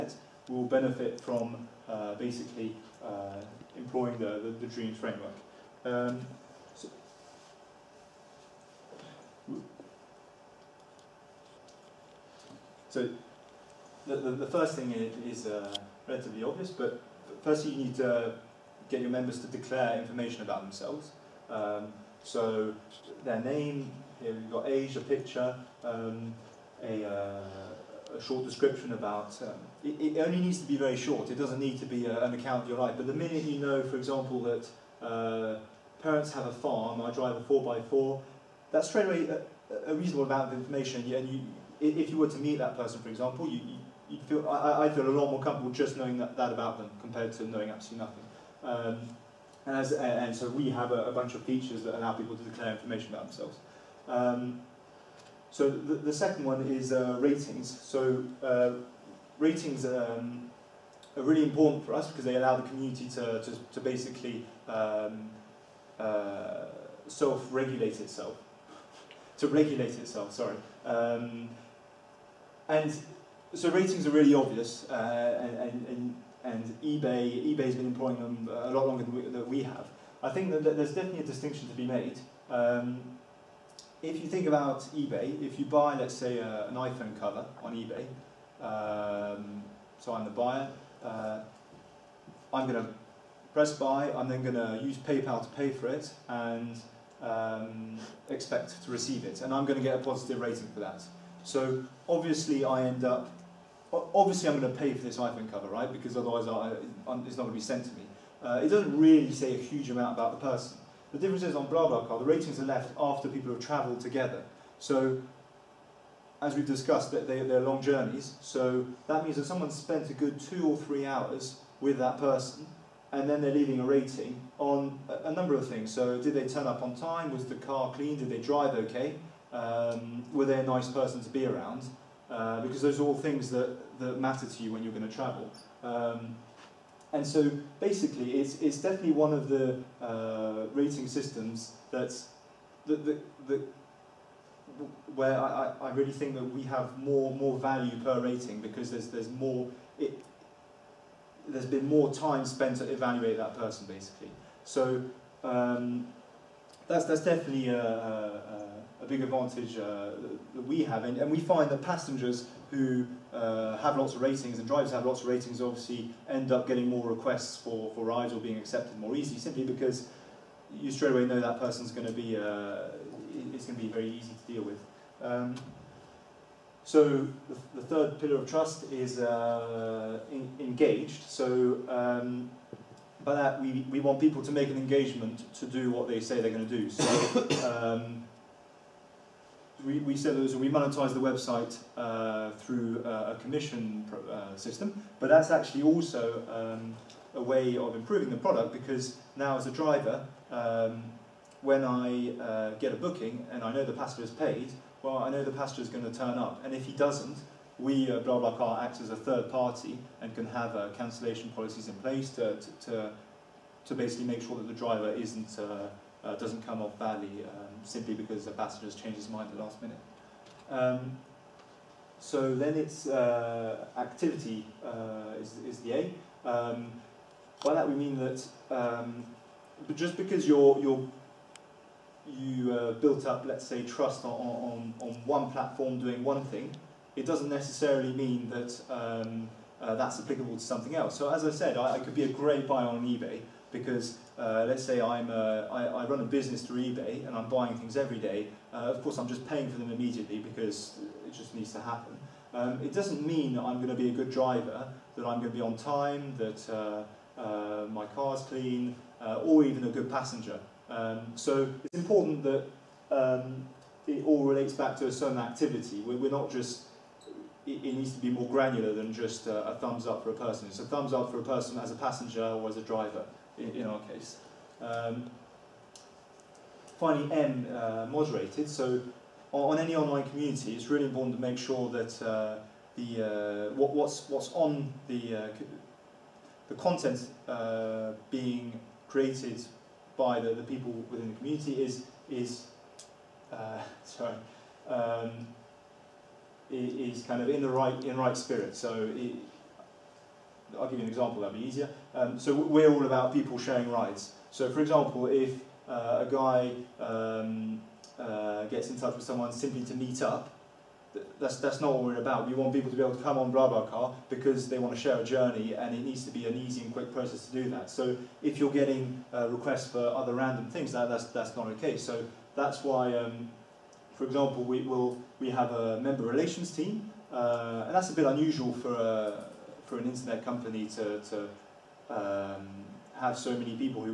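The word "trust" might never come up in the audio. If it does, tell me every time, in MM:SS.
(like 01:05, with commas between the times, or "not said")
02:58, 03:53.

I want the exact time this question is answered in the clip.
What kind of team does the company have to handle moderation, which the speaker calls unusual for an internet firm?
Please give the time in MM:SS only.
05:26.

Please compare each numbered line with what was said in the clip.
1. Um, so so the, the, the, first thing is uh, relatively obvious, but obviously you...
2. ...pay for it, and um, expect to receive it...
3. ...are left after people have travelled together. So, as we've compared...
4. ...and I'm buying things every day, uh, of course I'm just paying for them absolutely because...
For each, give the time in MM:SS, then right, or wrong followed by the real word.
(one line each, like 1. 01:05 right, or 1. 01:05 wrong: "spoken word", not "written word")
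1. 00:05 wrong: "firstly", not "obviously"
2. 01:35 right
3. 01:52 wrong: "discussed", not "compared"
4. 04:07 wrong: "immediately", not "absolutely".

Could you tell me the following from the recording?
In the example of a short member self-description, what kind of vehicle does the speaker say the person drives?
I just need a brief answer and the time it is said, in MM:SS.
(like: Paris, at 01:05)
4x4, at 00:37.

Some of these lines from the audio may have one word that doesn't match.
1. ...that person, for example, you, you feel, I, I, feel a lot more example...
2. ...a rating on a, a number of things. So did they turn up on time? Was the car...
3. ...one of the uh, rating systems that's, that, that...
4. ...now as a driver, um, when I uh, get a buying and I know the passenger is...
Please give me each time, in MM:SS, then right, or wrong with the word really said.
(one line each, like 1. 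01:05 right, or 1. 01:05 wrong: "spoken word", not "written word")
1. 00:42 wrong: "comfortable", not "example"
2. 02:03 right
3. 02:19 right
4. 03:19 wrong: "booking", not "buying".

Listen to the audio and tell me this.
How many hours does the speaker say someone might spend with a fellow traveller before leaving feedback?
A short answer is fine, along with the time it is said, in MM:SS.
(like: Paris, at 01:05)
2 or 3 hours, at 02:00.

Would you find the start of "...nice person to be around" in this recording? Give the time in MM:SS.
02:10.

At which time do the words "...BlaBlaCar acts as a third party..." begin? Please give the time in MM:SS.
03:28.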